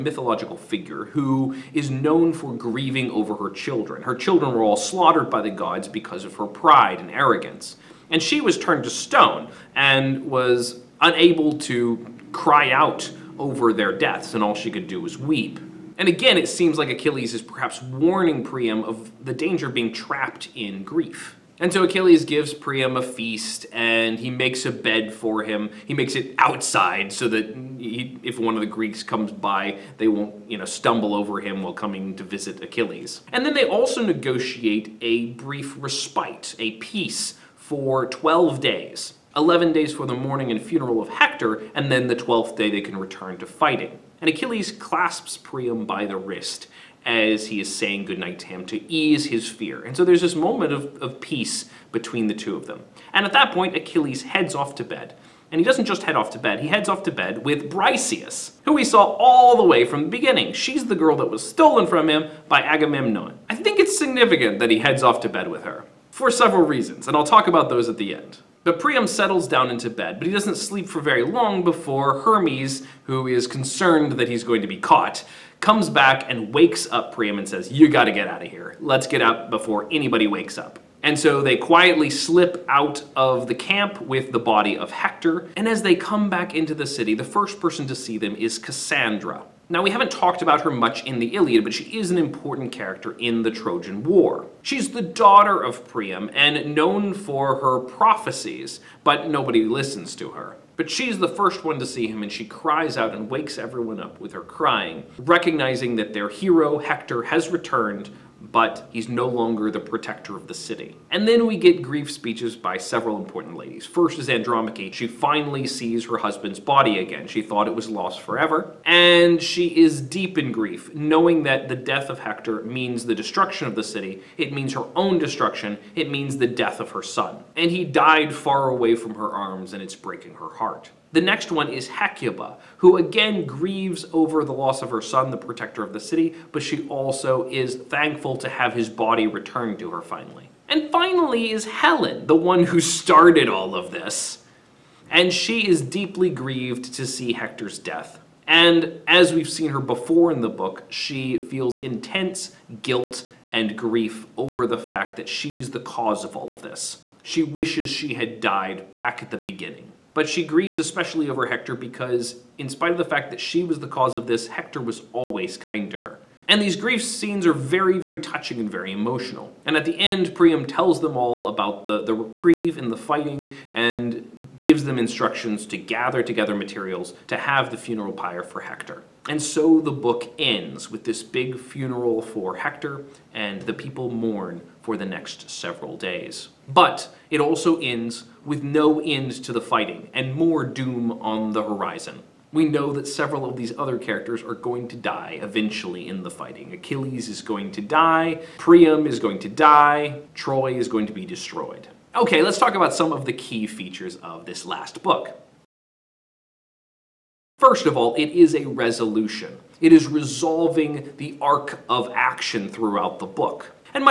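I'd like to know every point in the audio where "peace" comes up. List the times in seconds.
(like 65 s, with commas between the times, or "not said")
36 s, 51 s.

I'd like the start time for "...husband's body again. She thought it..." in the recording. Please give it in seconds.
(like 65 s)
116 s.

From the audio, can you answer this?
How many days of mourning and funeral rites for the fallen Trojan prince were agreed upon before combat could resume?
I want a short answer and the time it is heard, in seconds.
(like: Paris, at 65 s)
11, at 39 s.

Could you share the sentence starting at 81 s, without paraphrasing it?
And so they quietly slip out of the camp with the body of Hector.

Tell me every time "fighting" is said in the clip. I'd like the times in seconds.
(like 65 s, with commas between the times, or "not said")
43 s, 172 s, 189 s, 196 s.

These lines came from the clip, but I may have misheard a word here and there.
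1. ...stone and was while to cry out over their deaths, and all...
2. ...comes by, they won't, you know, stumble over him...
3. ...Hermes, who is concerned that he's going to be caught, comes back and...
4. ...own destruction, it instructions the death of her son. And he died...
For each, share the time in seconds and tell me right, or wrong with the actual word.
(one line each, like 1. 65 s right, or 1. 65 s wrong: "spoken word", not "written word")
1. 8 s wrong: "unable", not "while"
2. 29 s right
3. 72 s right
4. 124 s wrong: "means", not "instructions".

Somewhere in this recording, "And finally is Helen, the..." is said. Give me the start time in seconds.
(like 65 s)
140 s.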